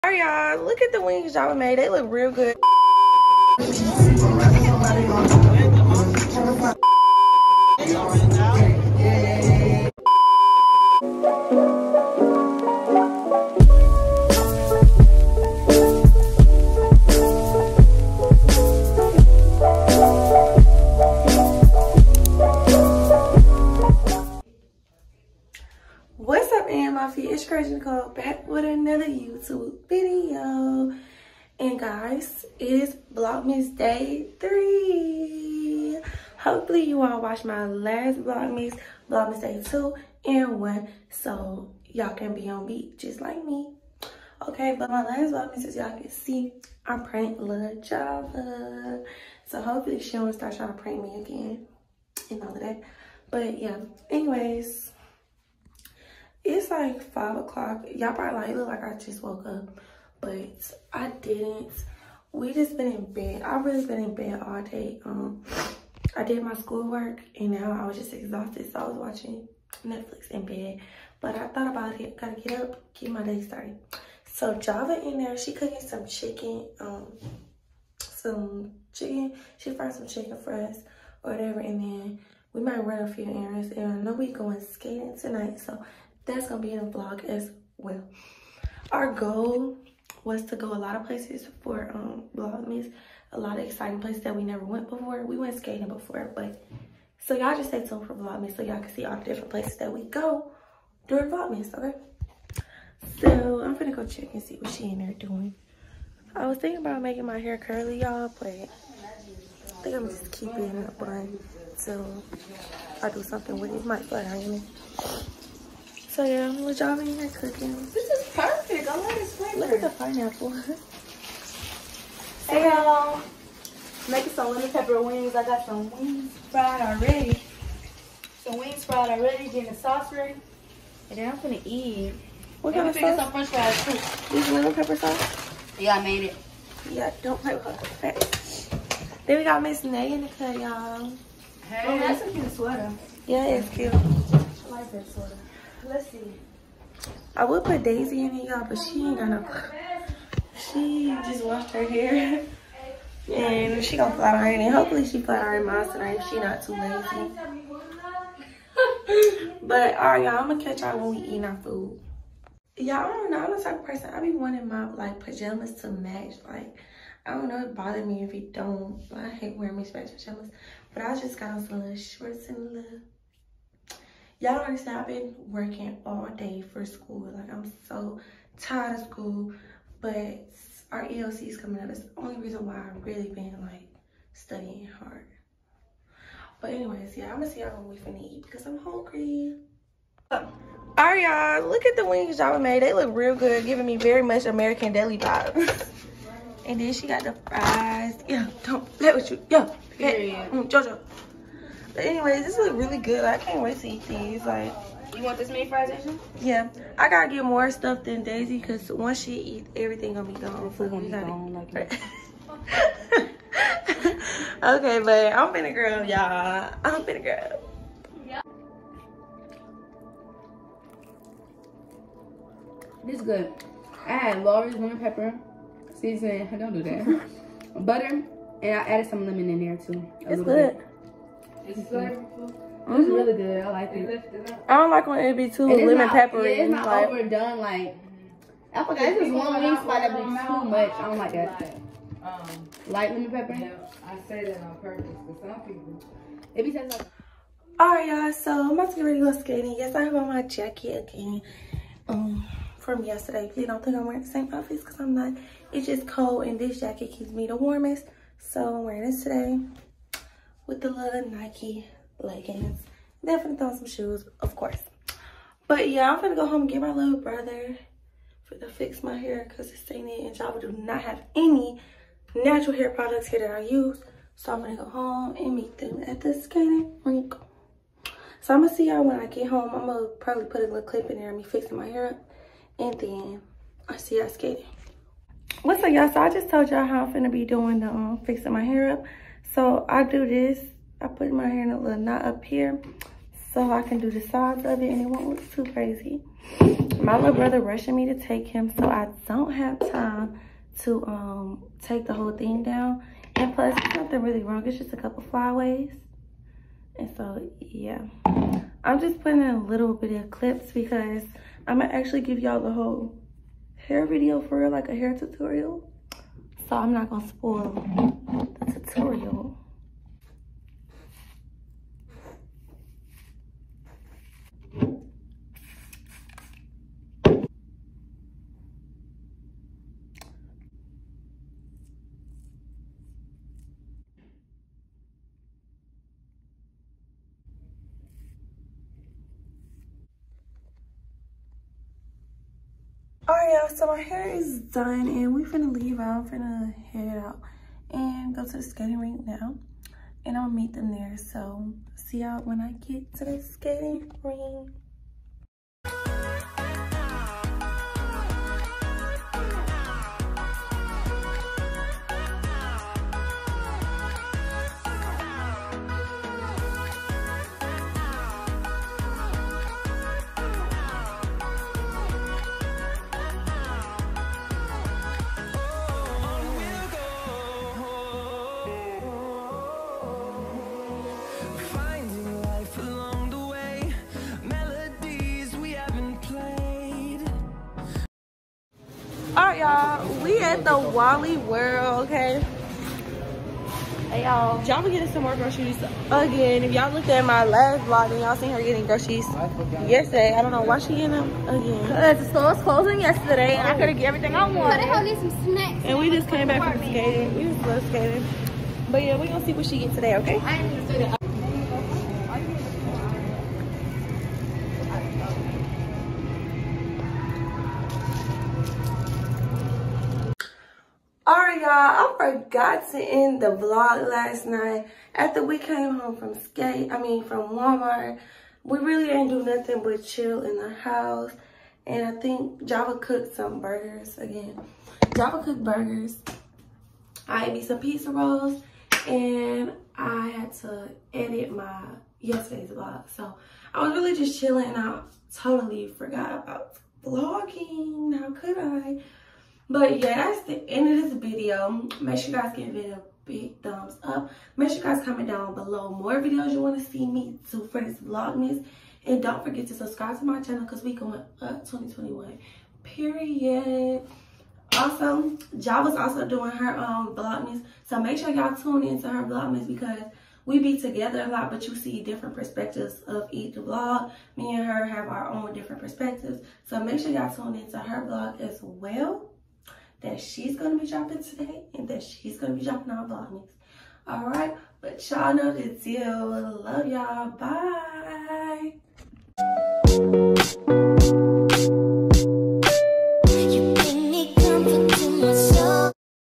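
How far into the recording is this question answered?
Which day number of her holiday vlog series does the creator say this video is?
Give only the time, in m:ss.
0:33.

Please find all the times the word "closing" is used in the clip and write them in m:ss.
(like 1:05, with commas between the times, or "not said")
6:42.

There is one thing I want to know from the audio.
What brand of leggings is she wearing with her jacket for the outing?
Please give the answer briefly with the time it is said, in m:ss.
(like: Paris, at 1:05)
Nike, at 4:21.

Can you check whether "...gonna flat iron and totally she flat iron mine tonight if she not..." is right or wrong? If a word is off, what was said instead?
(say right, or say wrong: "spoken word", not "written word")
wrong: "hopefully", not "totally".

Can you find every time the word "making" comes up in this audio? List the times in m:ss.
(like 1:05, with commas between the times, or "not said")
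1:47, 2:04.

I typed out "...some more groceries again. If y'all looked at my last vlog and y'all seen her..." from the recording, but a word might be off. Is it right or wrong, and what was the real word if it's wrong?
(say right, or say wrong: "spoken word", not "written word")
right.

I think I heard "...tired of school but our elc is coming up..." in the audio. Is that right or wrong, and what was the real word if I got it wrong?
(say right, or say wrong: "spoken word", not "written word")
right.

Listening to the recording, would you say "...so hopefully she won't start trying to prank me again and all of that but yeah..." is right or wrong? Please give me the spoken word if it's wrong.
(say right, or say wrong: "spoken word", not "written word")
right.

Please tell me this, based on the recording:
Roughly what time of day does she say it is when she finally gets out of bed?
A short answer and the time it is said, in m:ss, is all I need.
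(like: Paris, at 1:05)
5 o'clock, at 0:57.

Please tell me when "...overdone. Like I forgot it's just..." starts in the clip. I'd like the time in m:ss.
3:57.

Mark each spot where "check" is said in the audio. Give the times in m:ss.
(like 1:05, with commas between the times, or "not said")
1:44.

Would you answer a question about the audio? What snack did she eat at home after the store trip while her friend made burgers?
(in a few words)
Pizza rolls.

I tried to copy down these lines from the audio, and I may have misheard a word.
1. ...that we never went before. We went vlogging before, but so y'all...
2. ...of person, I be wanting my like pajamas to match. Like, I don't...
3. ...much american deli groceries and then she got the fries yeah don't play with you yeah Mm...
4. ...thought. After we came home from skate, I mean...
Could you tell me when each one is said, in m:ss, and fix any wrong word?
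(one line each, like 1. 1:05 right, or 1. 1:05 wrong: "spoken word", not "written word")
1. 1:34 wrong: "skating", not "vlogging"
2. 2:43 right
3. 3:14 wrong: "vibes", not "groceries"
4. 7:04 wrong: "night", not "thought".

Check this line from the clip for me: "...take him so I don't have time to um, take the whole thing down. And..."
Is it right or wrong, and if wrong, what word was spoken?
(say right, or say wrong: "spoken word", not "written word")
right.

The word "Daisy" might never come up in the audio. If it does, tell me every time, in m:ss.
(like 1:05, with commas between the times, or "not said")
2:27, 3:28.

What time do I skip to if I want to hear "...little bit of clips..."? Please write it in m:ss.
5:09.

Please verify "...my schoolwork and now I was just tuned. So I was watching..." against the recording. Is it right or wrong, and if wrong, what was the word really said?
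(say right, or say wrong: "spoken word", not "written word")
wrong: "exhausted", not "tuned".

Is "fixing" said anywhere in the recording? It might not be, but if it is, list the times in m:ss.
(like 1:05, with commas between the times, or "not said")
4:41, 4:48.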